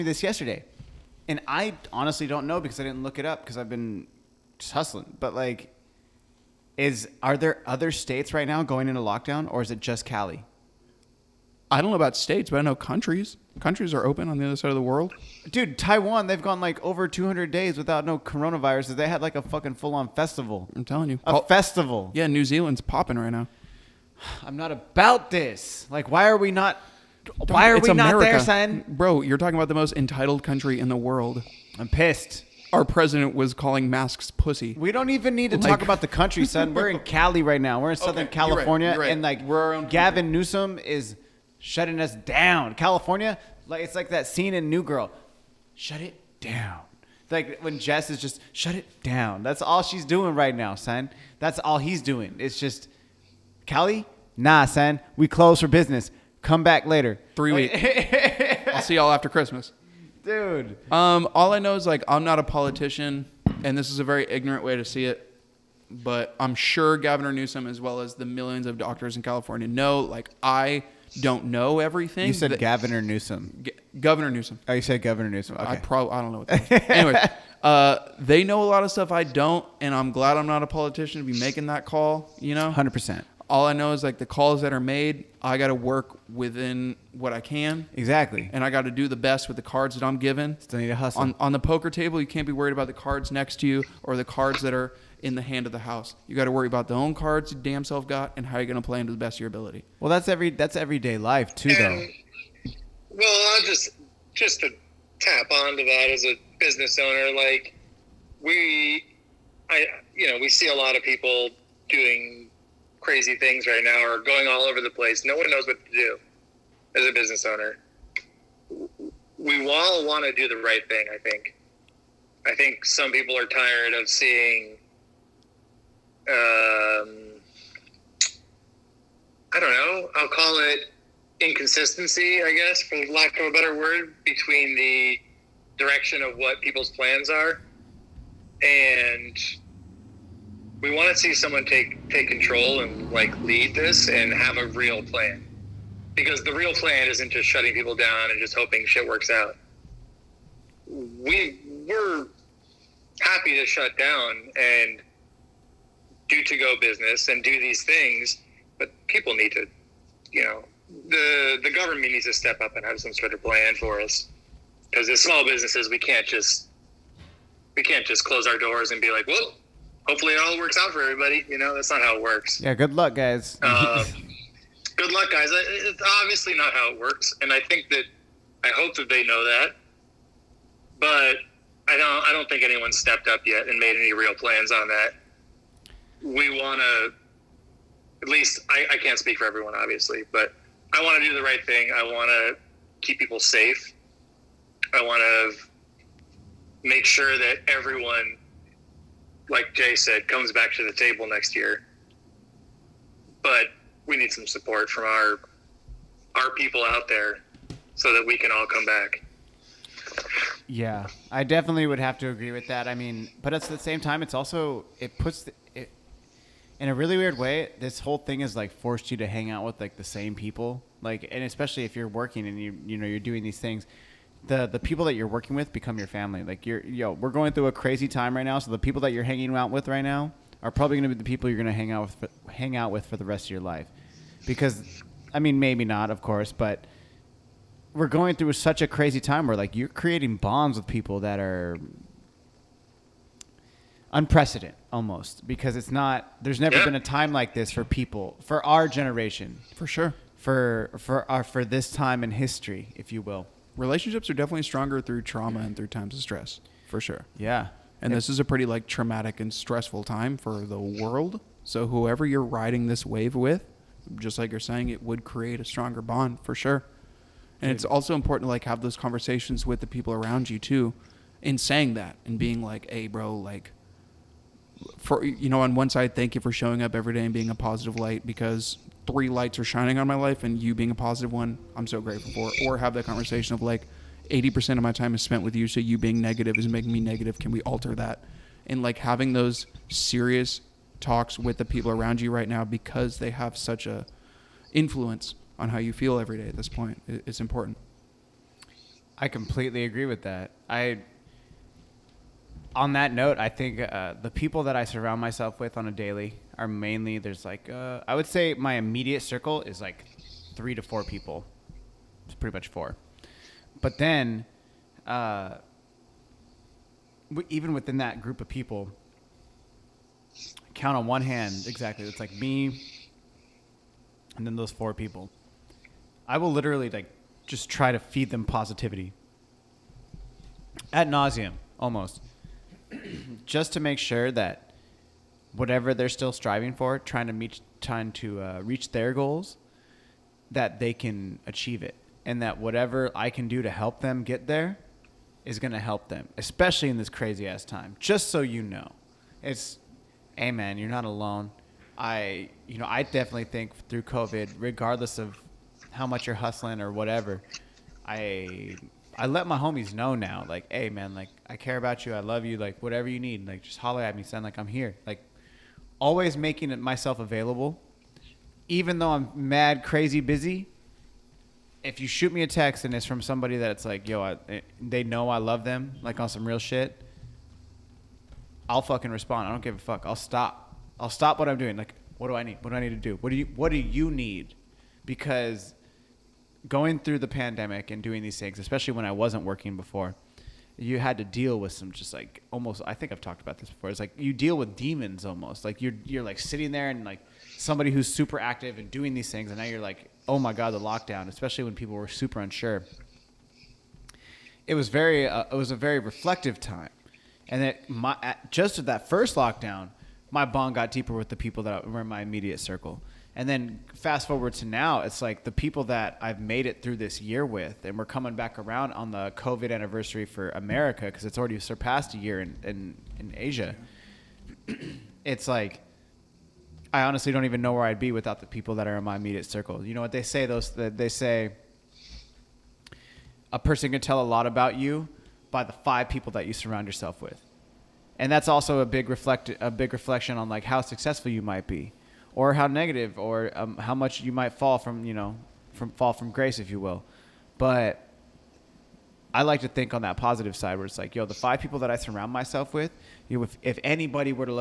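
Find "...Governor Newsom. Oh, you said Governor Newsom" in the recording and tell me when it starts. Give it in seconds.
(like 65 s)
73 s.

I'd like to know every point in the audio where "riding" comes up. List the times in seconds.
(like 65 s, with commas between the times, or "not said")
262 s.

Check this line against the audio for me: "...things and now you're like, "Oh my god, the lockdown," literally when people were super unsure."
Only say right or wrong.
wrong.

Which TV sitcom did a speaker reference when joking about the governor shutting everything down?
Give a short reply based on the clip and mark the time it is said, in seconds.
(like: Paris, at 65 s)
New Girl, at 44 s.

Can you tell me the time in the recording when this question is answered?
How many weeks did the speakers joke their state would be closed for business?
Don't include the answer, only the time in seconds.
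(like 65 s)
57 s.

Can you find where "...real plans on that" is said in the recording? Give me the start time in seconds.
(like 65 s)
184 s.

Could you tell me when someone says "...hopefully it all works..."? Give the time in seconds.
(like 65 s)
170 s.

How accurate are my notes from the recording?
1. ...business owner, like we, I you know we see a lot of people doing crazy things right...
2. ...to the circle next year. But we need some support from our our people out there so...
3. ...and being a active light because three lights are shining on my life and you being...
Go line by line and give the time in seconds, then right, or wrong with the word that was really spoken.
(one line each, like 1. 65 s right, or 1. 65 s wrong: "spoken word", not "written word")
1. 106 s right
2. 200 s wrong: "table", not "circle"
3. 277 s wrong: "positive", not "active".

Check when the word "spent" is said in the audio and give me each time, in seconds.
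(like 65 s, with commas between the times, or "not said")
285 s.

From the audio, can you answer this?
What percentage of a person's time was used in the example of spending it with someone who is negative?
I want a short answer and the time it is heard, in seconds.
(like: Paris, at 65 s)
80%, at 284 s.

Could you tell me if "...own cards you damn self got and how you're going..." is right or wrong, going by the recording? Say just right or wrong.
right.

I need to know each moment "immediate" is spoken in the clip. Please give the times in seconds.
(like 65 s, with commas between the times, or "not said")
308 s, 412 s, 429 s.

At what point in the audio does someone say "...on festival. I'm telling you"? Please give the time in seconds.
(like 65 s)
19 s.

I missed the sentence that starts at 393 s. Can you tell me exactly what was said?
It's like you deal with demons almost.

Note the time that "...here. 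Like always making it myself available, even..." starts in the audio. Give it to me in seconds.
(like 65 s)
364 s.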